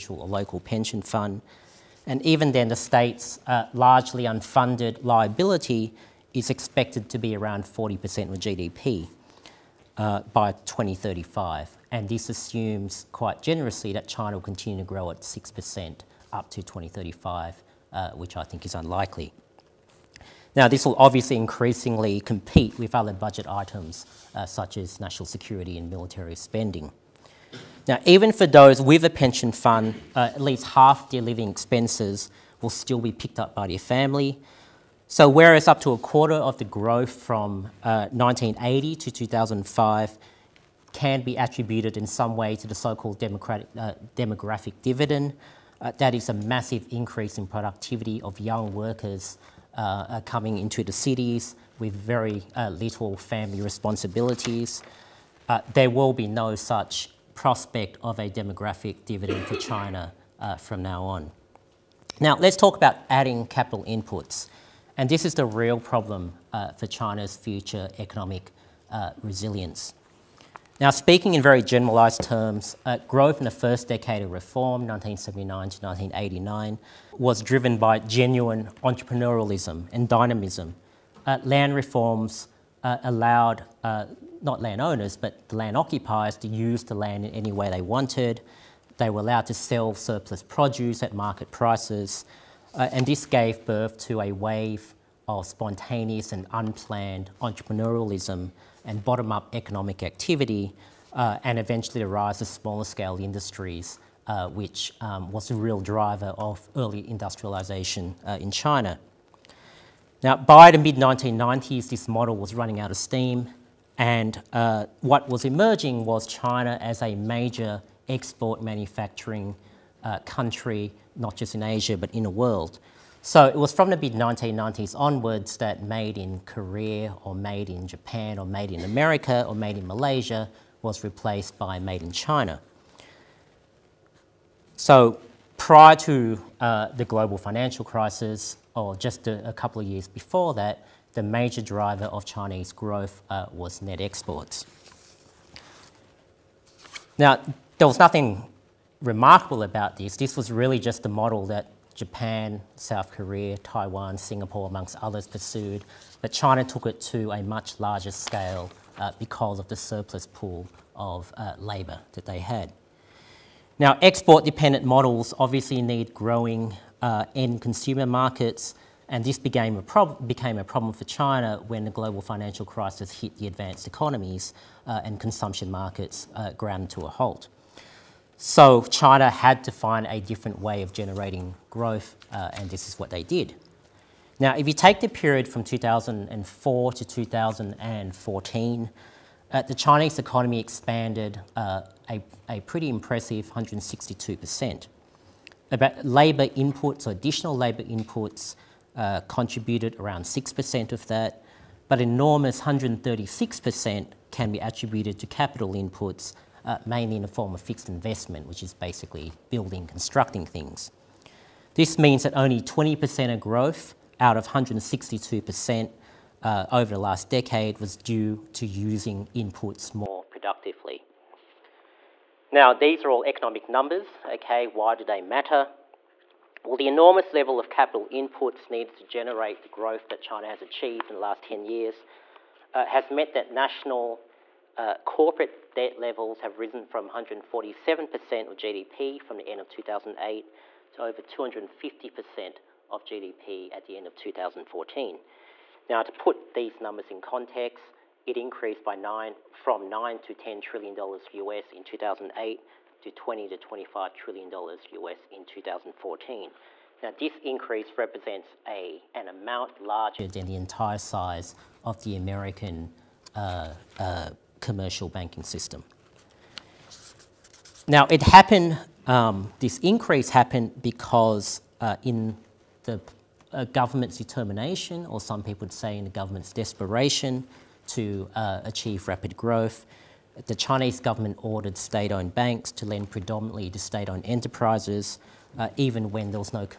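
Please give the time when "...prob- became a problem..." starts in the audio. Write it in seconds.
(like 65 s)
169 s.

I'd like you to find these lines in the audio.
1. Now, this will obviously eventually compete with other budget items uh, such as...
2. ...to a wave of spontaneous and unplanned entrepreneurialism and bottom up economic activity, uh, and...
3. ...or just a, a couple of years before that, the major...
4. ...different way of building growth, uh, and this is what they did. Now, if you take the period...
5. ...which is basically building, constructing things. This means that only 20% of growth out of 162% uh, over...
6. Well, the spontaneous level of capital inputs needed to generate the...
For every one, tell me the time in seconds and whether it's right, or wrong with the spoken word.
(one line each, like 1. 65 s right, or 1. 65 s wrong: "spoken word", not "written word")
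1. 20 s wrong: "increasingly", not "eventually"
2. 94 s right
3. 138 s right
4. 180 s wrong: "generating", not "building"
5. 208 s right
6. 226 s wrong: "enormous", not "spontaneous".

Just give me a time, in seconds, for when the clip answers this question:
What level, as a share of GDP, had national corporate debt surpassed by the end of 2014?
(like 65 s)
241 s.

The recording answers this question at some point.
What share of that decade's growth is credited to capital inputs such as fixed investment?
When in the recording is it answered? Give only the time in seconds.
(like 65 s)
202 s.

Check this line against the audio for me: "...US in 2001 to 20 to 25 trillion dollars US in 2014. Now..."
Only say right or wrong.
wrong.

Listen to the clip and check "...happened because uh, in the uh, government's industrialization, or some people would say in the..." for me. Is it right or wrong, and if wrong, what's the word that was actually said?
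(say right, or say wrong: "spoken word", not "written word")
wrong: "determination", not "industrialization".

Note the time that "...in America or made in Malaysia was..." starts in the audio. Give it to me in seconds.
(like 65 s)
128 s.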